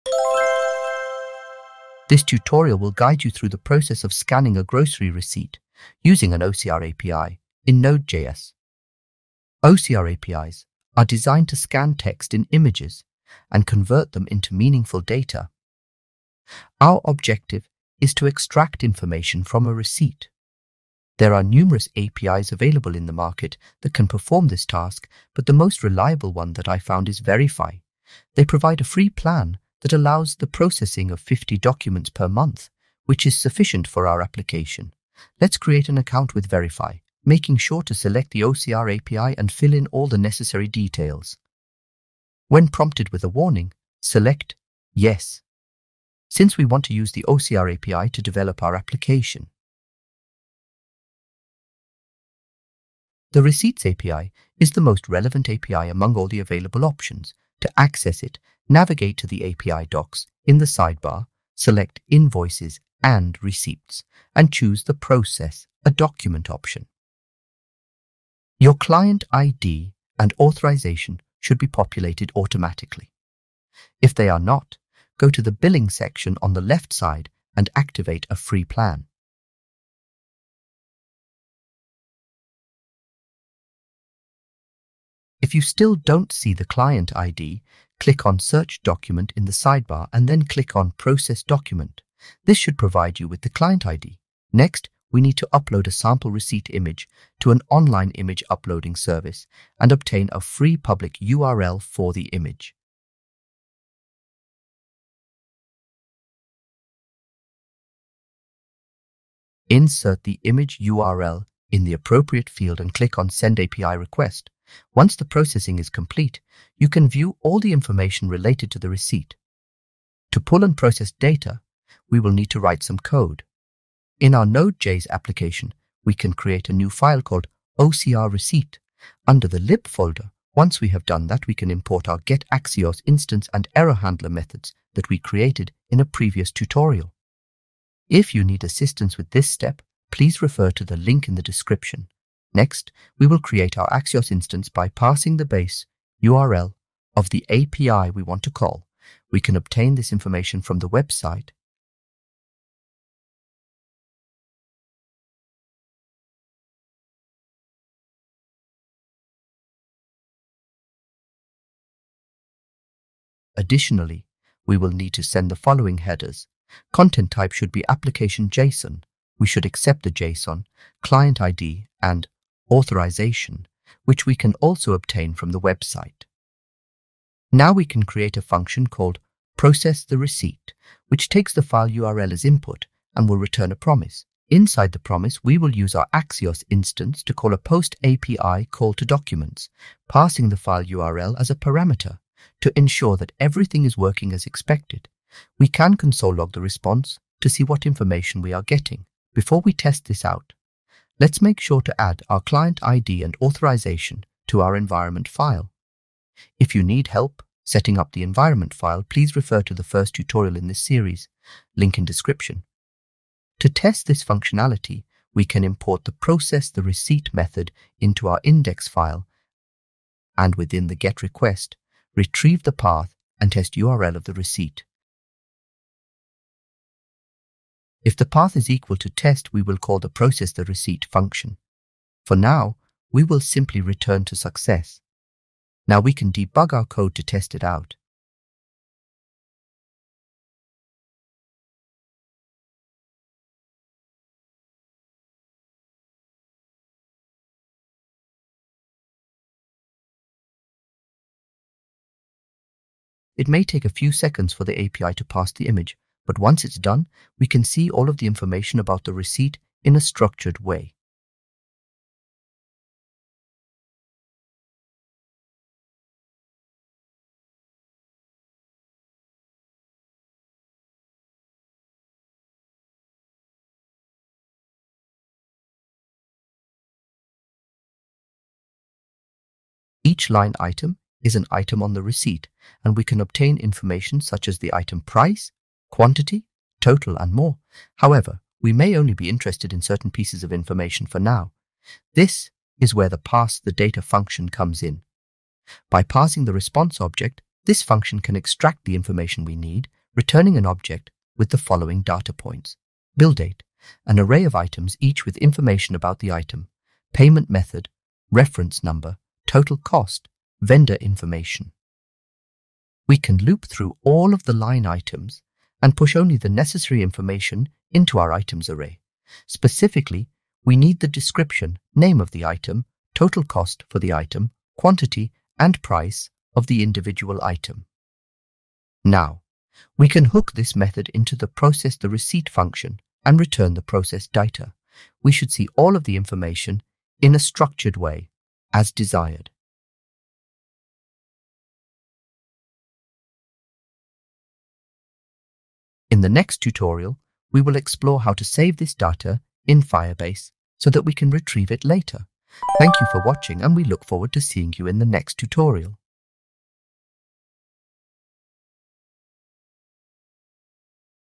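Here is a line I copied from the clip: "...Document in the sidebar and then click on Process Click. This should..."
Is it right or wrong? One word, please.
wrong.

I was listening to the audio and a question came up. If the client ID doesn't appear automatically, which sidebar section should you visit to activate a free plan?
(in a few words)
Billing.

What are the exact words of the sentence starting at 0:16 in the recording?
Our objective is to extract information from a receipt.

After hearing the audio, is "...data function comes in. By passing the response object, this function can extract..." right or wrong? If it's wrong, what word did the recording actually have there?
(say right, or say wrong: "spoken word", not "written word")
right.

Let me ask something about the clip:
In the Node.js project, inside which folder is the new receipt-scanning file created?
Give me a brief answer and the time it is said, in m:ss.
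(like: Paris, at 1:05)
lib, at 2:09.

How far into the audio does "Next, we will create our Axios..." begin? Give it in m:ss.
2:22.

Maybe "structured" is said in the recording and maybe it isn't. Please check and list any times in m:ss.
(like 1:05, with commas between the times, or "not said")
4:19, 5:37.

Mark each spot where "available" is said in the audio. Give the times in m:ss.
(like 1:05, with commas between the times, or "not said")
0:22, 0:56.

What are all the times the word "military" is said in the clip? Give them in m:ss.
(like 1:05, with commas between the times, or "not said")
not said.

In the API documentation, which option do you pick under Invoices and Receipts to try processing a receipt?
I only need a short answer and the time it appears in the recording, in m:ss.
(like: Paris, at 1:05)
Process a Document, at 1:04.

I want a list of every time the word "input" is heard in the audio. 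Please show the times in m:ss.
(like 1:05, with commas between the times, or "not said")
3:02.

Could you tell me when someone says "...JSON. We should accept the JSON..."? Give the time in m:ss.
2:48.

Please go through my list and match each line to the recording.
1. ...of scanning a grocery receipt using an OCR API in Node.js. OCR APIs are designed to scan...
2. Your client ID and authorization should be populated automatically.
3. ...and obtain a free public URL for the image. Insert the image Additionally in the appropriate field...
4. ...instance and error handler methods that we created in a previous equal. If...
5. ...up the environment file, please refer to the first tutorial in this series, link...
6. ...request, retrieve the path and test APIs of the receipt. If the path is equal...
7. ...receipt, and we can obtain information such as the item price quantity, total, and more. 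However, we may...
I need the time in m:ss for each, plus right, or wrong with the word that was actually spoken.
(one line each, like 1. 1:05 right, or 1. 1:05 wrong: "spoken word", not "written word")
1. 0:04 right
2. 1:08 right
3. 1:39 wrong: "URL", not "Additionally"
4. 2:13 wrong: "tutorial", not "equal"
5. 3:27 right
6. 3:41 wrong: "URL", not "APIs"
7. 4:42 right.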